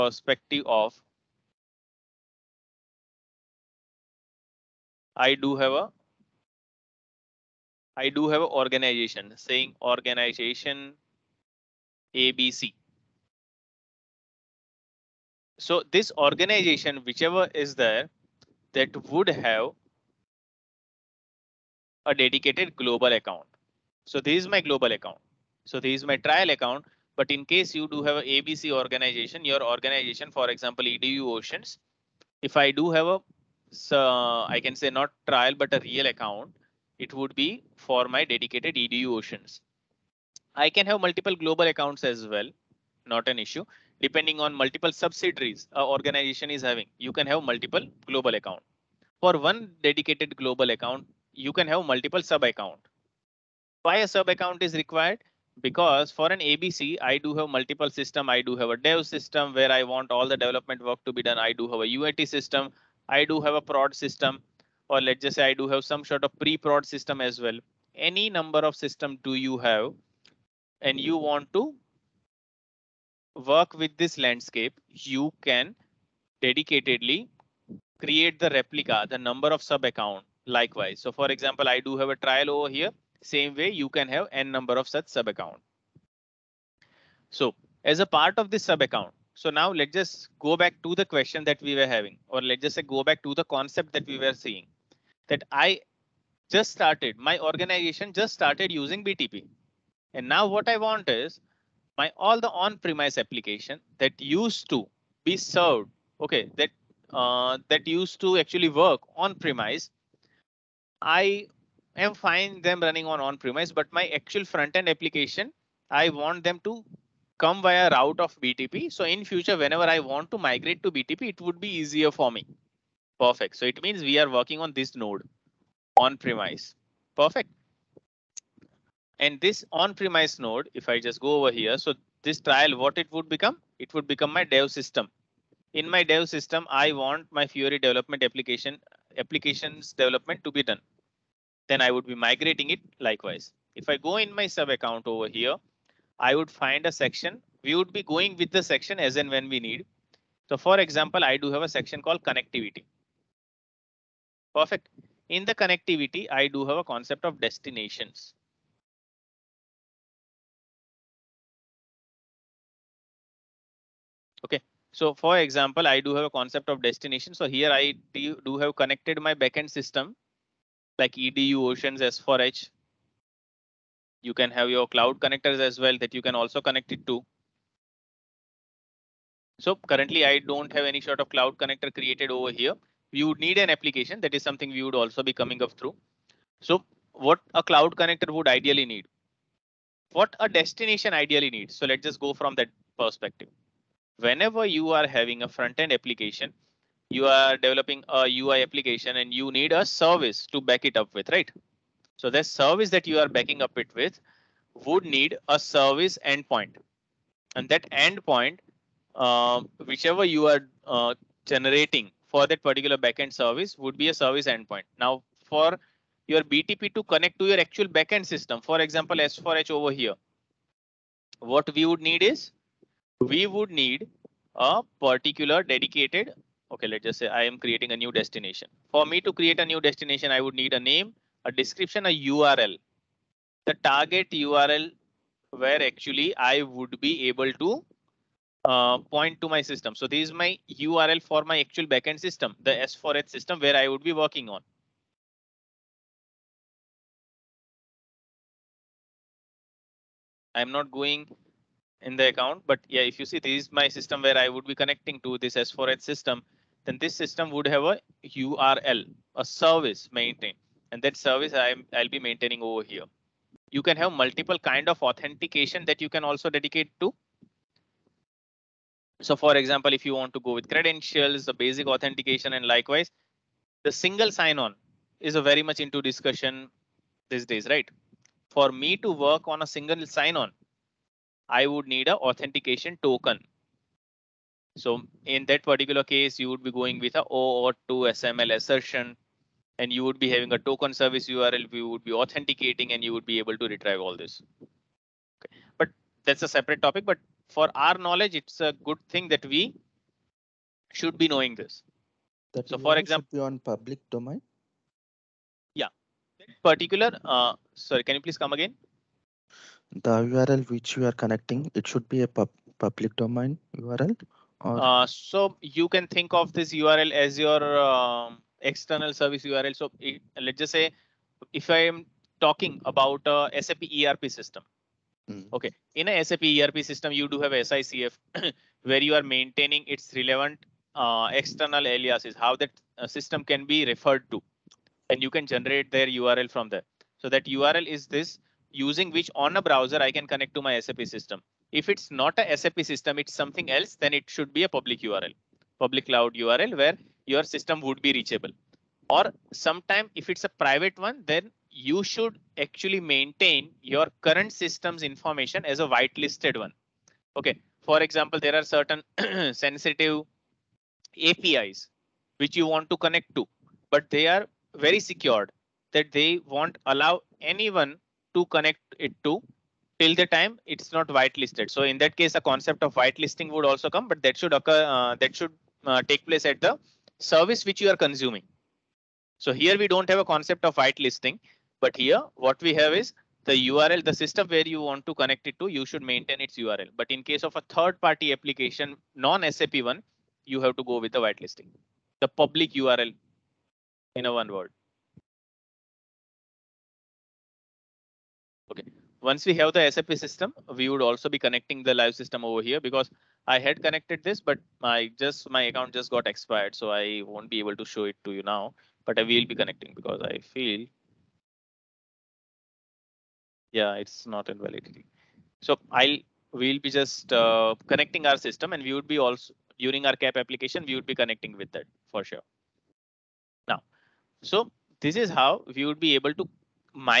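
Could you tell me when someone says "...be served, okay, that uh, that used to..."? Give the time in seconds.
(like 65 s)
105 s.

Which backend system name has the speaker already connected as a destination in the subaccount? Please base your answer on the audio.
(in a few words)
S4H.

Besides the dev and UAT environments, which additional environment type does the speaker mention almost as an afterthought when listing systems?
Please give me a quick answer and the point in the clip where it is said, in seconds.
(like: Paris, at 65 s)
pre-prod, at 66 s.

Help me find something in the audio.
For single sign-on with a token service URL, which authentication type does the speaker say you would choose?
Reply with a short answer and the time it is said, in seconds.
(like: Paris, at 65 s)
OAuth 2 SAML assertion, at 287 s.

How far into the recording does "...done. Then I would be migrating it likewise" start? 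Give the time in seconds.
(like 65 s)
140 s.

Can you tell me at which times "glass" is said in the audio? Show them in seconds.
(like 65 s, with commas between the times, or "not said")
not said.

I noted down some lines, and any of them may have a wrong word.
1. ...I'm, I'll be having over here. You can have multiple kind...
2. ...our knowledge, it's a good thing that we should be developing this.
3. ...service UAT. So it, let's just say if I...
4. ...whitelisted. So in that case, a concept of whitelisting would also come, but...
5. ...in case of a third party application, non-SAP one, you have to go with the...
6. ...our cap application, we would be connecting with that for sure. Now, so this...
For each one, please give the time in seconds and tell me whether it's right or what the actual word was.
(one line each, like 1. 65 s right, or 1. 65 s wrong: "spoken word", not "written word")
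1. 261 s wrong: "maintaining", not "having"
2. 297 s wrong: "knowing", not "developing"
3. 319 s wrong: "URL", not "UAT"
4. 371 s right
5. 387 s right
6. 420 s right.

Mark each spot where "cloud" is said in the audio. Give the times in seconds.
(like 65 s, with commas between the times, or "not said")
174 s, 181 s, 187 s, 346 s.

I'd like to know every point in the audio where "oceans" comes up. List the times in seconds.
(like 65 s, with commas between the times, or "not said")
31 s, 39 s, 171 s.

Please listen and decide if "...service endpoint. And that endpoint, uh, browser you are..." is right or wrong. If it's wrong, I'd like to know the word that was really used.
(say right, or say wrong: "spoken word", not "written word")
wrong: "whichever", not "browser".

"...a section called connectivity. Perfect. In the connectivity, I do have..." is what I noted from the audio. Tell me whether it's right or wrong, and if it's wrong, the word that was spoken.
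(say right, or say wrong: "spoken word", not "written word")
right.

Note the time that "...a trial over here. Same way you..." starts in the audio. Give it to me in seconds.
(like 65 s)
82 s.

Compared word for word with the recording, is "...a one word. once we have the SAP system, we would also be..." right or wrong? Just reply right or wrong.
right.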